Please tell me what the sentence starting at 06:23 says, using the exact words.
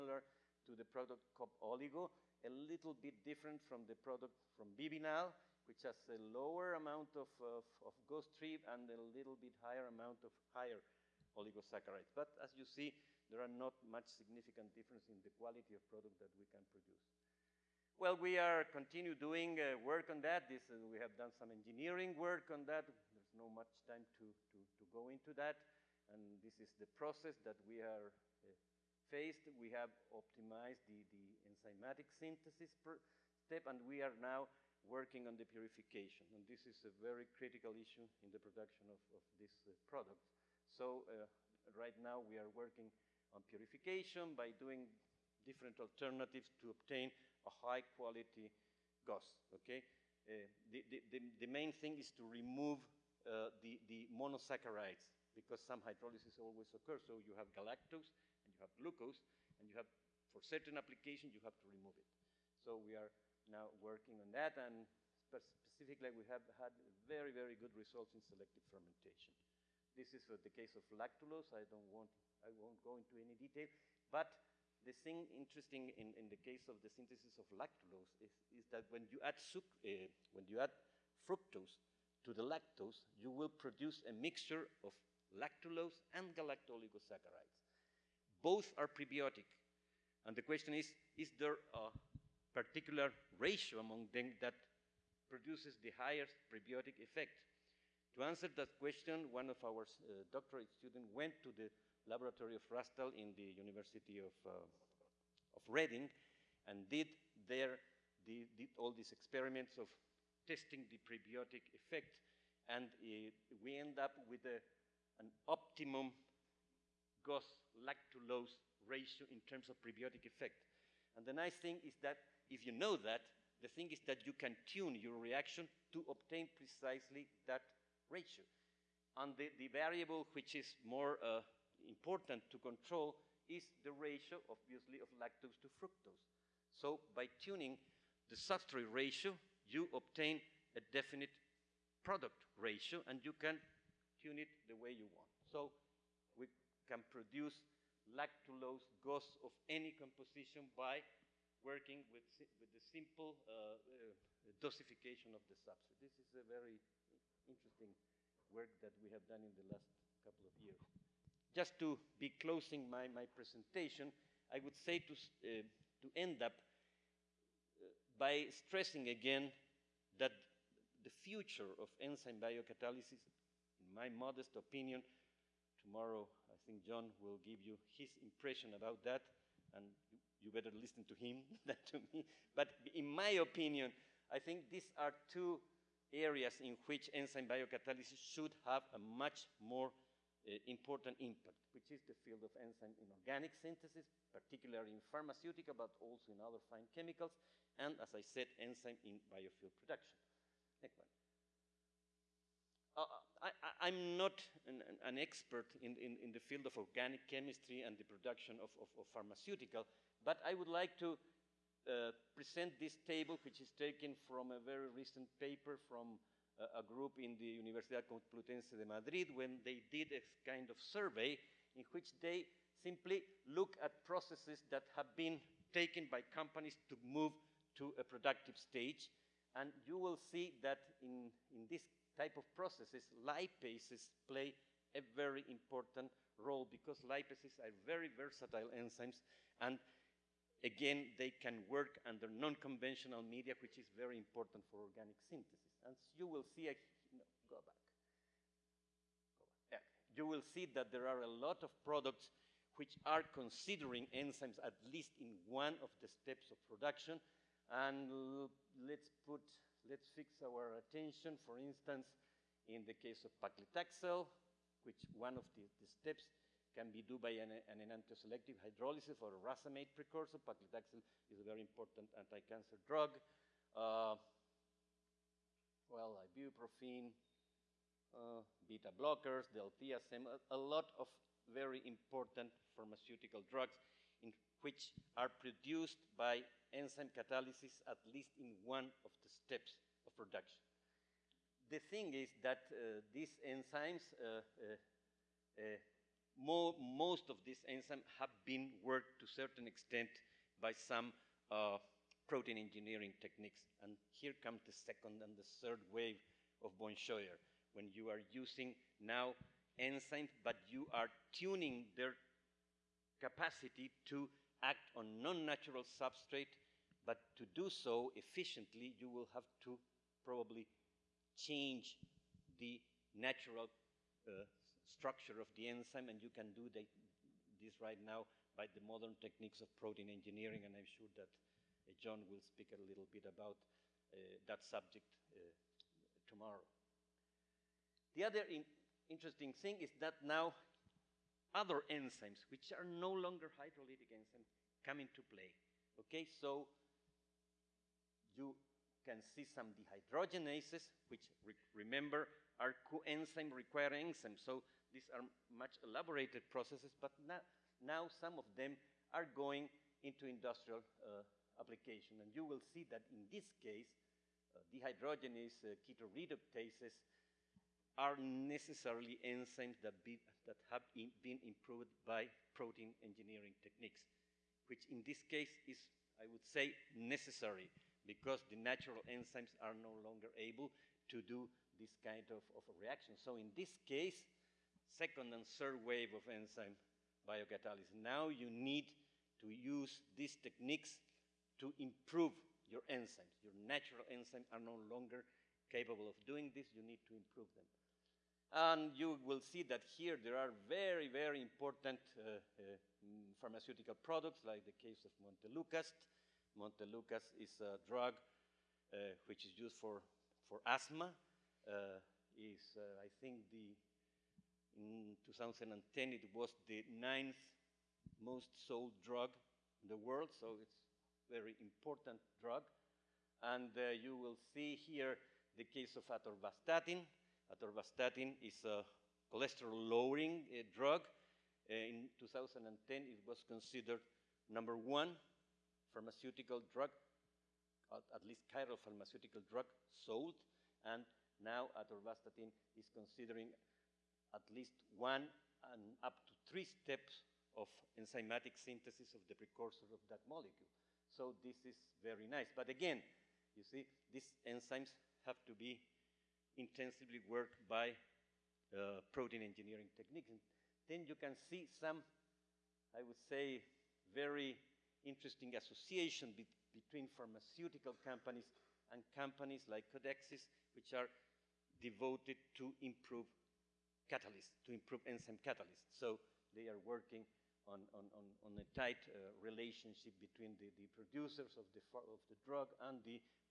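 So in this case, second and third wave of enzyme biocatalysis.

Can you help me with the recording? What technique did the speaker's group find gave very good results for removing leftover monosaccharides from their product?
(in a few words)
Selective fermentation.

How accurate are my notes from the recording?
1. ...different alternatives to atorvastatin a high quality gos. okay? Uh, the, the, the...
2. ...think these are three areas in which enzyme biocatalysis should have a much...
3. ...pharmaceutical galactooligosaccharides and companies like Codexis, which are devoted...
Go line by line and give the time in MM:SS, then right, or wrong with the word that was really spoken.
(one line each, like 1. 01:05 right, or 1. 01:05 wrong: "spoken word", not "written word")
1. 00:45 wrong: "obtain", not "atorvastatin"
2. 03:04 wrong: "two", not "three"
3. 07:47 wrong: "companies", not "galactooligosaccharides".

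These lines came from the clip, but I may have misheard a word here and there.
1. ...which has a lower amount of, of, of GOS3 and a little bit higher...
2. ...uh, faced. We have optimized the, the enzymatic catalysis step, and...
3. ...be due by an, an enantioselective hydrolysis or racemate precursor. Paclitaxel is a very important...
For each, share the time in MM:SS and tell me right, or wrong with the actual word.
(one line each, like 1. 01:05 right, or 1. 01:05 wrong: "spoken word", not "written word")
1. 00:05 right
2. 00:28 wrong: "synthesis", not "catalysis"
3. 04:26 right.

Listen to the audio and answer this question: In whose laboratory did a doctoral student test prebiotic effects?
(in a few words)
Rastall.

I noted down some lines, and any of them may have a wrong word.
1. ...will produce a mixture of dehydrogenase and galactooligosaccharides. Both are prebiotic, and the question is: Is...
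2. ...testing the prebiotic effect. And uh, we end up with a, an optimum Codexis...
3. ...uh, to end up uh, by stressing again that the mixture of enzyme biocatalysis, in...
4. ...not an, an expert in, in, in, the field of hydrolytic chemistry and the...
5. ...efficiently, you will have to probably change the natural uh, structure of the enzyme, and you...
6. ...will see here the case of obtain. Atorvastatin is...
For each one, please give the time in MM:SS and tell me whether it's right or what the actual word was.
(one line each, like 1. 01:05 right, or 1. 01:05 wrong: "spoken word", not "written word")
1. 01:23 wrong: "lactulose", not "dehydrogenase"
2. 01:50 wrong: "GOS", not "Codexis"
3. 02:45 wrong: "future", not "mixture"
4. 03:24 wrong: "organic", not "hydrolytic"
5. 05:18 right
6. 07:04 wrong: "atorvastatin", not "obtain".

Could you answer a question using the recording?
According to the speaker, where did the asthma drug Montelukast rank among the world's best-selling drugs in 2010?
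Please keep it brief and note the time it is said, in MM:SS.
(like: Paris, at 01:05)
Ninth, at 06:56.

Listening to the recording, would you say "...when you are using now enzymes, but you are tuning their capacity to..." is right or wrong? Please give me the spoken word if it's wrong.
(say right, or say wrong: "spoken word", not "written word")
right.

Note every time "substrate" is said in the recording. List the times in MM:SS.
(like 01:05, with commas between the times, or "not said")
02:18, 02:35, 05:15.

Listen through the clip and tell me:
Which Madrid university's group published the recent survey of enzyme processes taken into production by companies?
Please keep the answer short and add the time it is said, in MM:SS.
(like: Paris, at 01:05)
Universidad Complutense de Madrid, at 03:37.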